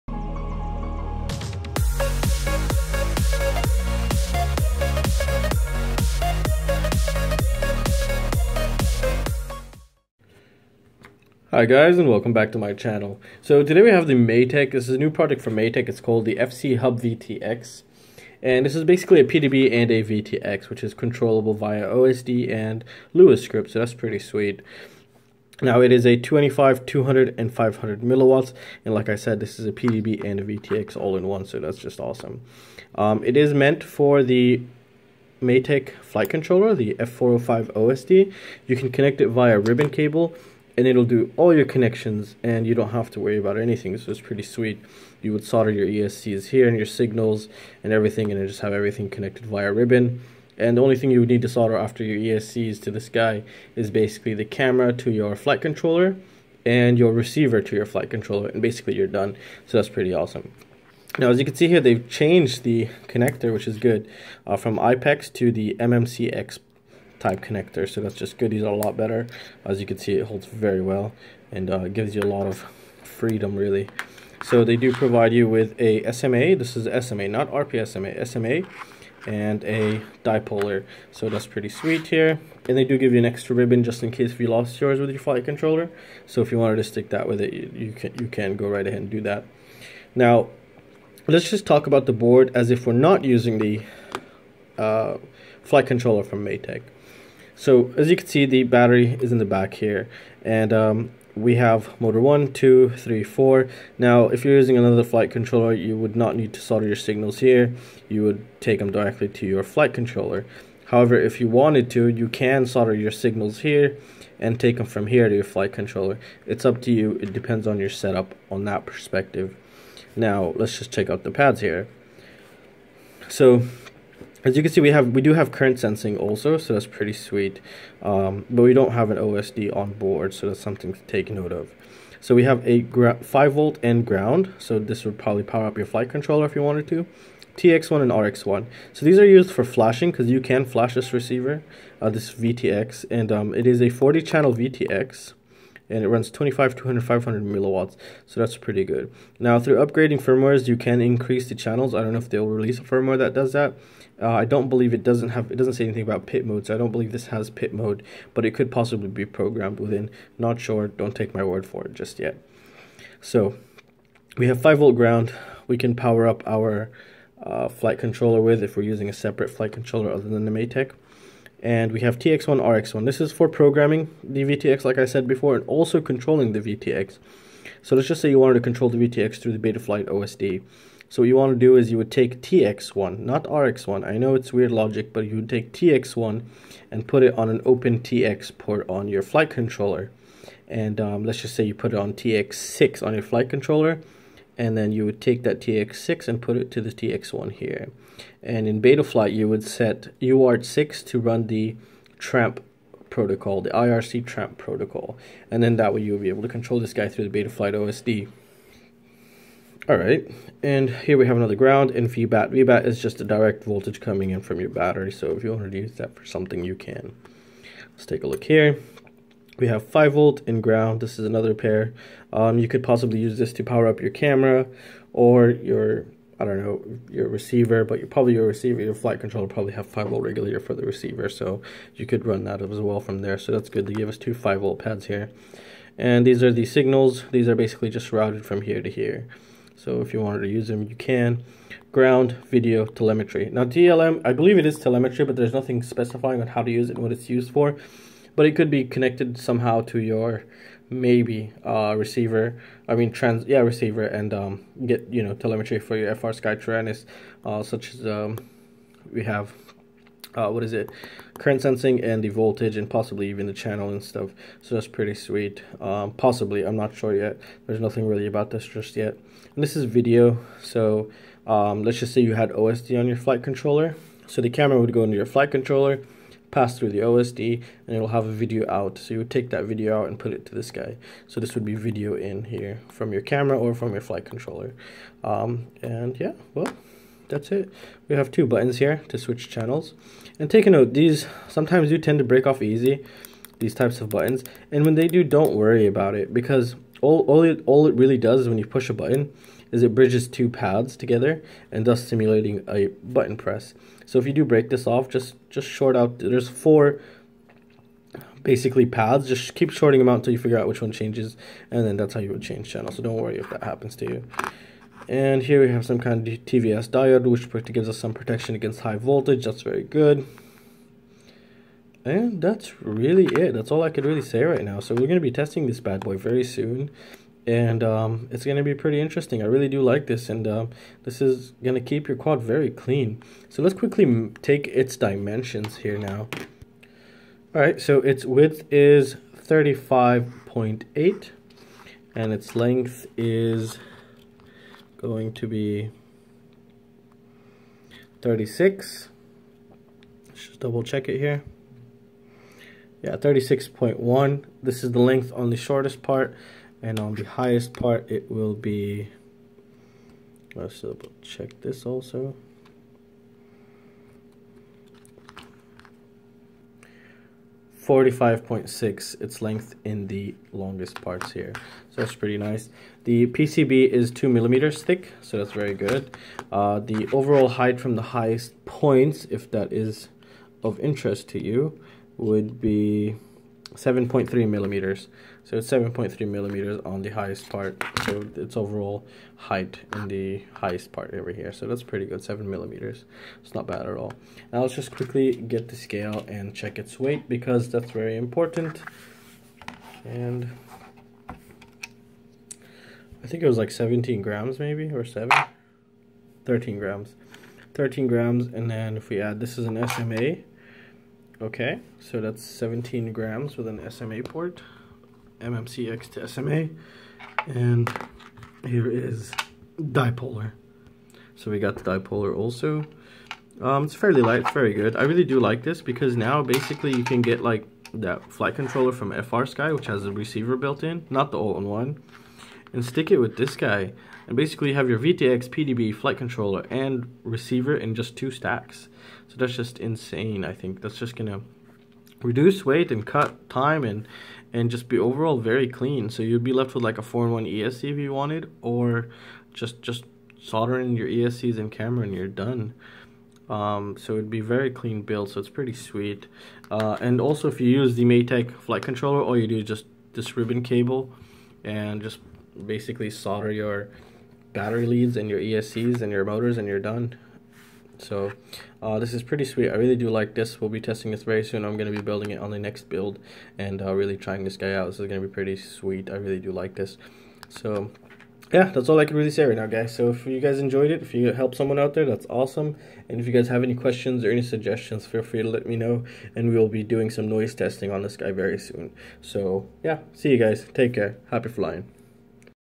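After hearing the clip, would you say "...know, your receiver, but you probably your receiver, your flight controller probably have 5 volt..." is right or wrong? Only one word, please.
right.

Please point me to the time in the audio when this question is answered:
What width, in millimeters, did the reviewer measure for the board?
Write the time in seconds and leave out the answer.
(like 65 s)
339 s.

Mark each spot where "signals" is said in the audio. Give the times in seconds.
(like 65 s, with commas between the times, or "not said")
46 s, 106 s, 113 s, 236 s.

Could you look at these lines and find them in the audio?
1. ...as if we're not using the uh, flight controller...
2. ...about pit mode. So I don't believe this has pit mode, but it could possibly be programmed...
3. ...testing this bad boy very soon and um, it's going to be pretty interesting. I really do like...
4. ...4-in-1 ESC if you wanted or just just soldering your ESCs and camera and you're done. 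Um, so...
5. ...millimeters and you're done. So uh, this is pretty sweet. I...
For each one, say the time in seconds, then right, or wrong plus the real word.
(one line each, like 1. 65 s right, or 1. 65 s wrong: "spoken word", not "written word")
1. 92 s right
2. 156 s right
3. 325 s right
4. 447 s right
5. 466 s wrong: "motors", not "millimeters".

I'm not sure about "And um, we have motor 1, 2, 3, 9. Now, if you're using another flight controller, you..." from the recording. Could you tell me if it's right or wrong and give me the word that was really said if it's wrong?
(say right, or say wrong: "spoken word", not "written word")
wrong: "4", not "9".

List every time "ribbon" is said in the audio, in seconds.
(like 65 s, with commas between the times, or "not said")
39 s, 49 s, 83 s, 460 s.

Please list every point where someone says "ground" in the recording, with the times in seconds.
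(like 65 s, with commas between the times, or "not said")
134 s, 164 s, 211 s, 220 s, 241 s.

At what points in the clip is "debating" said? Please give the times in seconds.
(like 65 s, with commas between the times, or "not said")
not said.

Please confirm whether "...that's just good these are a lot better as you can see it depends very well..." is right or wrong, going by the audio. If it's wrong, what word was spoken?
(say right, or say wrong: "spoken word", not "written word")
wrong: "holds", not "depends".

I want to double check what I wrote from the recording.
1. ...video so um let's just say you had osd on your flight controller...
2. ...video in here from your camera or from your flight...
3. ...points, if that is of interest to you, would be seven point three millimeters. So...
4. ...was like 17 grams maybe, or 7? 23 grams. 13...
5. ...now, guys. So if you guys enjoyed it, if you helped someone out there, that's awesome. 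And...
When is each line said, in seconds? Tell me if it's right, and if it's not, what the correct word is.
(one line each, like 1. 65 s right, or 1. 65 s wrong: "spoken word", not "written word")
1. 269 s right
2. 281 s right
3. 378 s right
4. 403 s wrong: "13", not "23"
5. 479 s right.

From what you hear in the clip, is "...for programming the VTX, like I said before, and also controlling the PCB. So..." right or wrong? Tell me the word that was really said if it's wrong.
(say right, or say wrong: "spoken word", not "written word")
wrong: "VTX", not "PCB".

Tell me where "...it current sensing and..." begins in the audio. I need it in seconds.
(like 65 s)
260 s.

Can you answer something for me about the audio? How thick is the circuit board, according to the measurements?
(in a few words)
2 millimeters.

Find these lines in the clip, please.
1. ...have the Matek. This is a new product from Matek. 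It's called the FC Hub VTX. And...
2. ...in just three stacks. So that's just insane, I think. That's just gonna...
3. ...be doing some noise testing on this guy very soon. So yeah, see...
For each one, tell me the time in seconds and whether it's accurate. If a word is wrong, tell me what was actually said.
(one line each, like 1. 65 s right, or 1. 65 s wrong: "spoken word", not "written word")
1. 13 s right
2. 437 s wrong: "two", not "three"
3. 486 s right.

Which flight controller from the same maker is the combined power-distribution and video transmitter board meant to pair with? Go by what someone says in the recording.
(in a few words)
F405 OSD.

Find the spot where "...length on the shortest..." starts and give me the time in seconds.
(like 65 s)
354 s.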